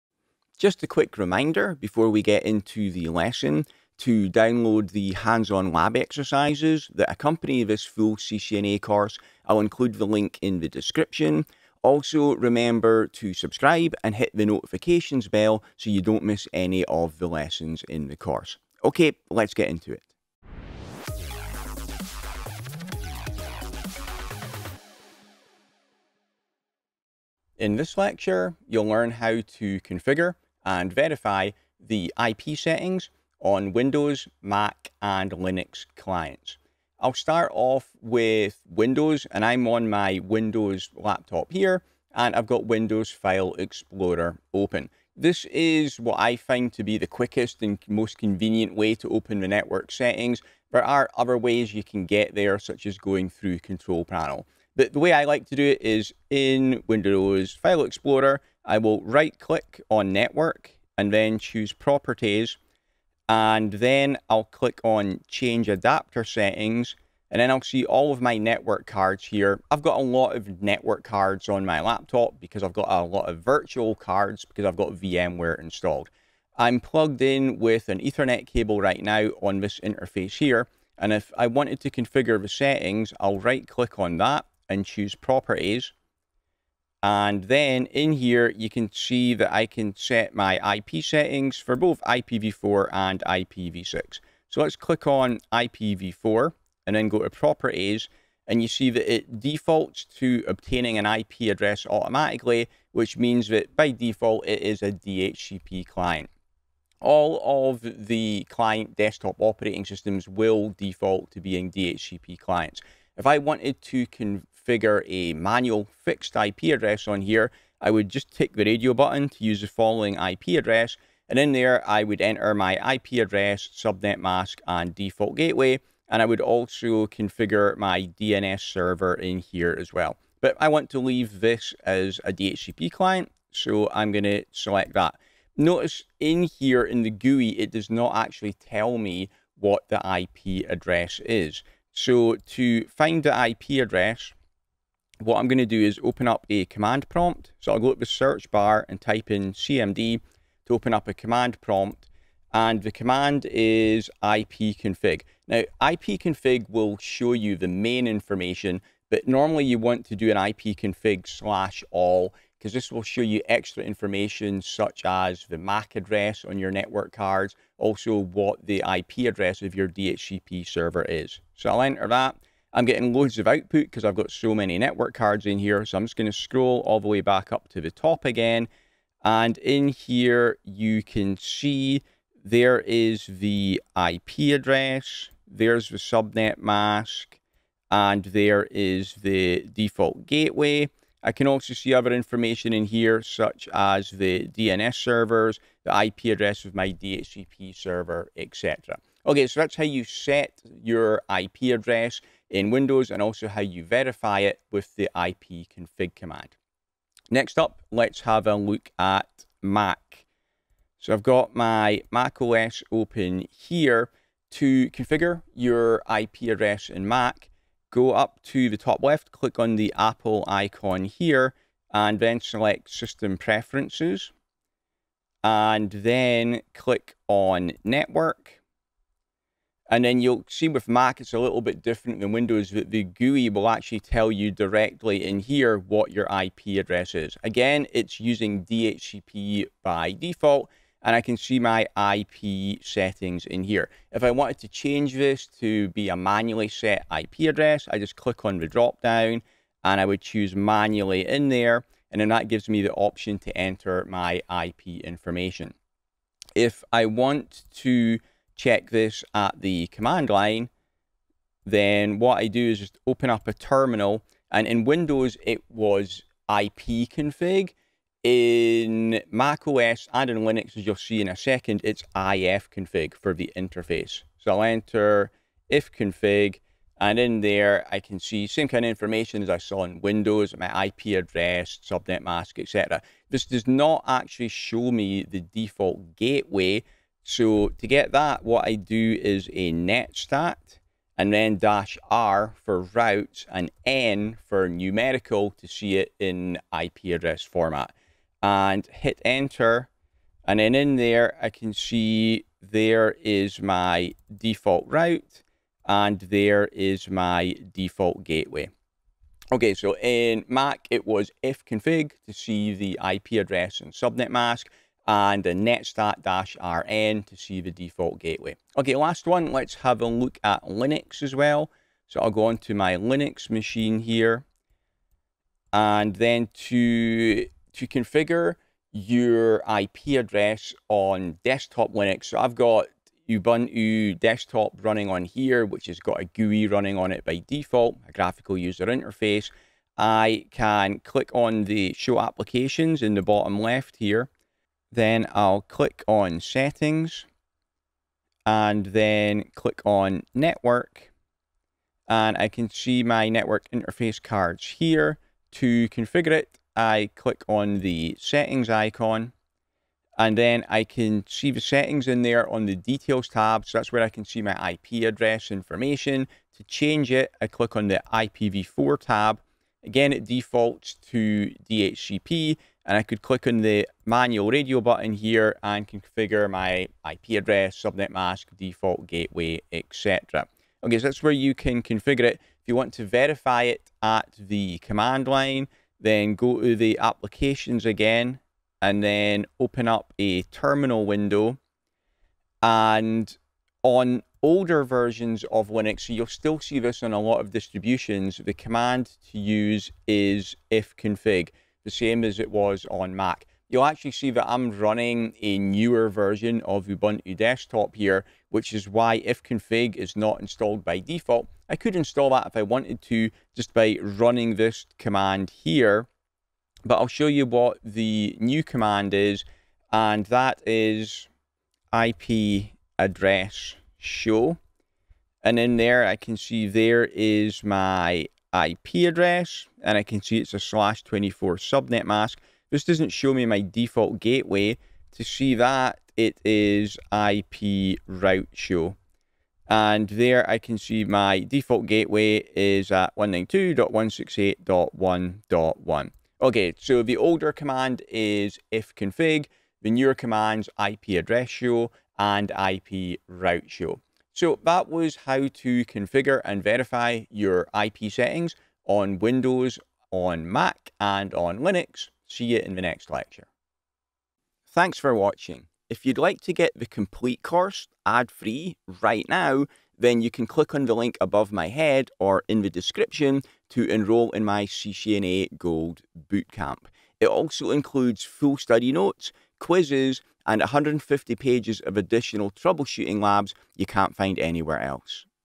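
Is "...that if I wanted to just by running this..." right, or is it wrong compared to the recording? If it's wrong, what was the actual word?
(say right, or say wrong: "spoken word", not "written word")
right.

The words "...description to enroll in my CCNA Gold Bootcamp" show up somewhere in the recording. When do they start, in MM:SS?
07:52.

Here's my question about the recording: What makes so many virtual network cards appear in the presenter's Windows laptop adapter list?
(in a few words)
VMware installed.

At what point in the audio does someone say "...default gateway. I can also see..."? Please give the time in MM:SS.
03:09.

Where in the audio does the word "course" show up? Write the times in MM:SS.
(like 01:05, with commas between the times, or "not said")
00:08, 00:18, 07:47.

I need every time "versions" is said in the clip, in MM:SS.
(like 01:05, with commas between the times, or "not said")
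06:34, 06:46.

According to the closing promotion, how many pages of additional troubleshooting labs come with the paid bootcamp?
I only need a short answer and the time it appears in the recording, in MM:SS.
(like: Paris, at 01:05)
150, at 08:00.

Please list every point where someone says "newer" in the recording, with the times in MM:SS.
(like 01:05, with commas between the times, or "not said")
06:45, 07:29.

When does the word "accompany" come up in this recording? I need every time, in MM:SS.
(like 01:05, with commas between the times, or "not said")
00:07.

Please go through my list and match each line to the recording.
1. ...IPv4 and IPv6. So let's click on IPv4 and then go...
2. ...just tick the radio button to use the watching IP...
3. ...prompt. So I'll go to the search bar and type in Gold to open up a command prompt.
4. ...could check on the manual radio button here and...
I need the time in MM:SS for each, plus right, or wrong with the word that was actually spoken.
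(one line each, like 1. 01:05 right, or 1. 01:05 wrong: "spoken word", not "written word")
1. 01:32 right
2. 01:58 wrong: "following", not "watching"
3. 02:27 wrong: "CMD", not "Gold"
4. 06:13 wrong: "click", not "check".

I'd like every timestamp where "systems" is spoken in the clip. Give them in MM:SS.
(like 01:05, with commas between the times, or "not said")
01:49, 03:42.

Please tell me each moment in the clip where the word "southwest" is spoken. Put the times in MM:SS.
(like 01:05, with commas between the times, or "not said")
not said.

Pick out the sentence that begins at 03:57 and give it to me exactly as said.
Again, it's using DHCP by default, and I can see my IP settings in here.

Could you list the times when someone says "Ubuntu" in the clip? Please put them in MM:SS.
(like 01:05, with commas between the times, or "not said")
05:33, 06:46.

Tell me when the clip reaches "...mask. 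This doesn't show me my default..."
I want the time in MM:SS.
07:12.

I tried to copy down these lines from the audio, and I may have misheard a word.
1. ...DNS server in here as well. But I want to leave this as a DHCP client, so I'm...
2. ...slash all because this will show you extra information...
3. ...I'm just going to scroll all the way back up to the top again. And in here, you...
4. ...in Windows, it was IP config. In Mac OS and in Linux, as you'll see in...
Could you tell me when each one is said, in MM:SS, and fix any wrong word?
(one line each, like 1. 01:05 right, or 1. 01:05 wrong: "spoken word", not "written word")
1. 02:08 right
2. 02:41 right
3. 02:55 right
4. 04:24 right.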